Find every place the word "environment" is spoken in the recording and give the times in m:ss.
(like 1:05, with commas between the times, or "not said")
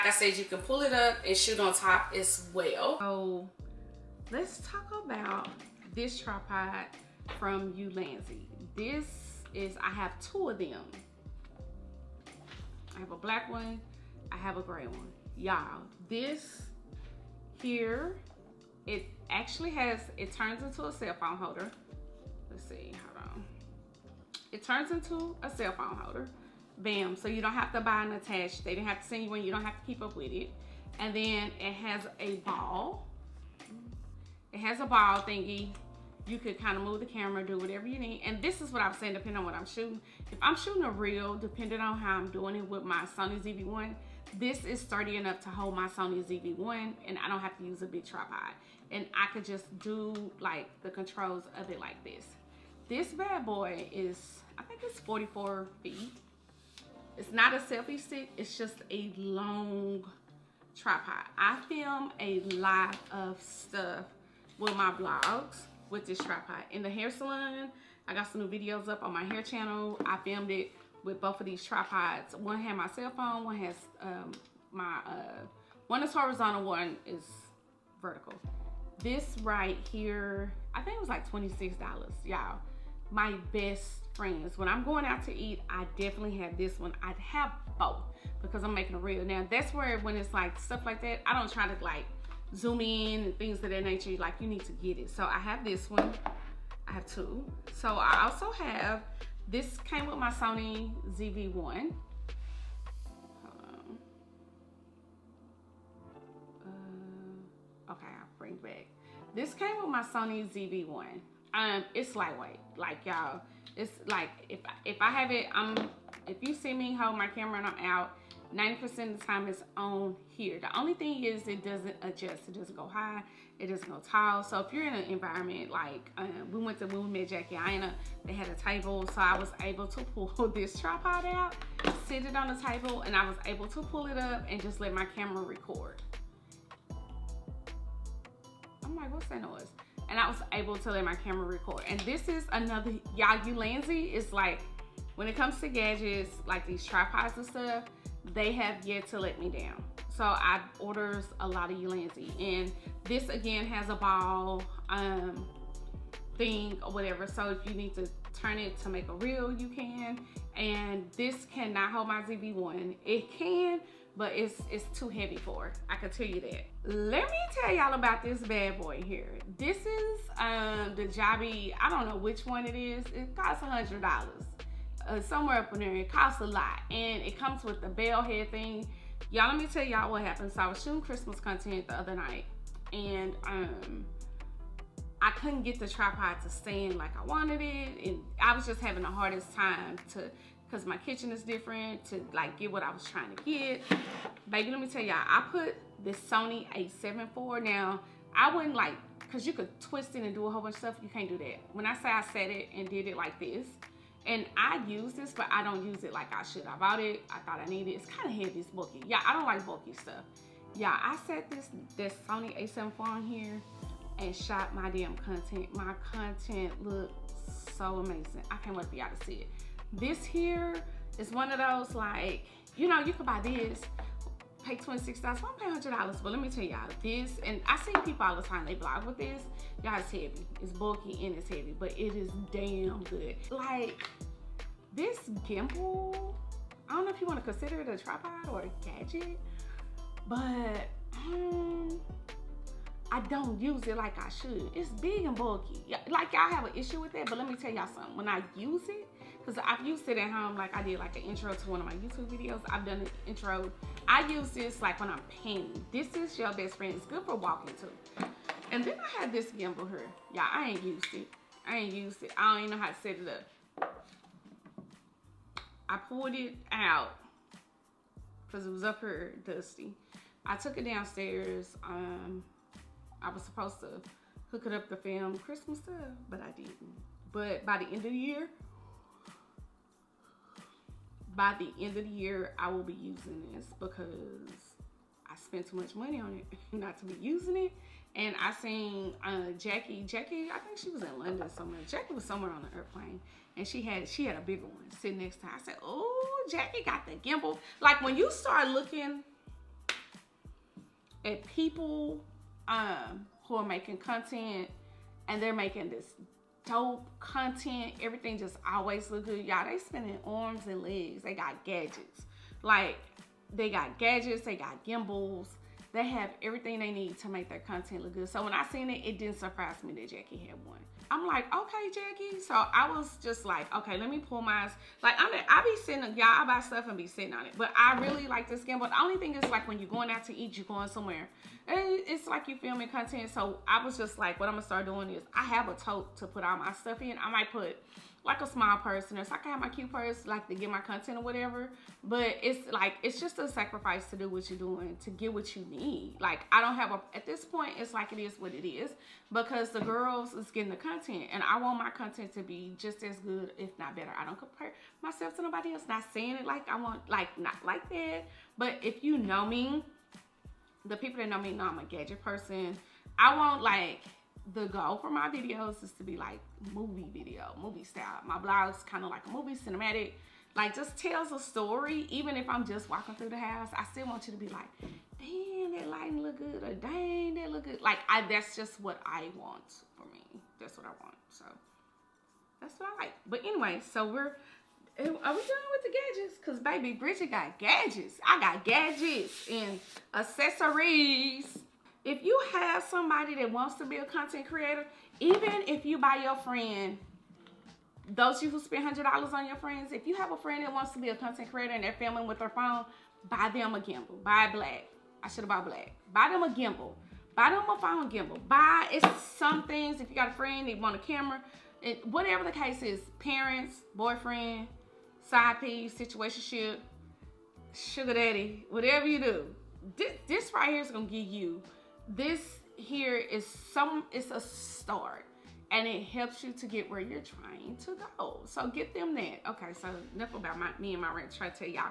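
2:05.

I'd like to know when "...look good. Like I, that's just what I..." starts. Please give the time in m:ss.
6:17.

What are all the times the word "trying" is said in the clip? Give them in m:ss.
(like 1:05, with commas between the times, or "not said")
3:13, 7:07.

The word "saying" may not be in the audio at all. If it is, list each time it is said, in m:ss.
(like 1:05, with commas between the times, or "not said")
0:38, 5:56.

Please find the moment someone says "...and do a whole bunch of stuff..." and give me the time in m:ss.
3:20.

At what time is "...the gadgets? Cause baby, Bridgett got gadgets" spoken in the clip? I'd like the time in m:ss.
6:25.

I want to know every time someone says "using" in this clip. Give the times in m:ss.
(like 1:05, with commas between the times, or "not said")
4:42, 4:47.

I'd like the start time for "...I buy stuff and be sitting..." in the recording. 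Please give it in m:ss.
5:26.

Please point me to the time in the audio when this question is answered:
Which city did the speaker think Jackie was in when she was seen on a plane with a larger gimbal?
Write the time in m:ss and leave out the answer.
4:51.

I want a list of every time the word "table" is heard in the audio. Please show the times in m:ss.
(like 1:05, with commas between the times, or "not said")
2:08, 2:12.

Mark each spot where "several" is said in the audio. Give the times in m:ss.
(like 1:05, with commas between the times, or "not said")
not said.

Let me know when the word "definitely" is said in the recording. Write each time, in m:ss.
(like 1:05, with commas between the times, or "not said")
1:25.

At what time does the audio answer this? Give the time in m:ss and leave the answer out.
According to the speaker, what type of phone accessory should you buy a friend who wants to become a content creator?
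6:47.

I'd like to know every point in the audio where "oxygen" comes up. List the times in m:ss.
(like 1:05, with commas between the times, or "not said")
not said.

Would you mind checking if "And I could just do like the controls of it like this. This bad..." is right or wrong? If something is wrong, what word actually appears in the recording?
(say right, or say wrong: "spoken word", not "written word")
right.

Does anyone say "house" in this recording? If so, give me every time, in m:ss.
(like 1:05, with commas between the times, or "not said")
6:13.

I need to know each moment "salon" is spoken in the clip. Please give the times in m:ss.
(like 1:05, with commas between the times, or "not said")
1:07.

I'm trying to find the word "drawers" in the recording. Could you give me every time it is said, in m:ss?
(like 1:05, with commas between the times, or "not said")
not said.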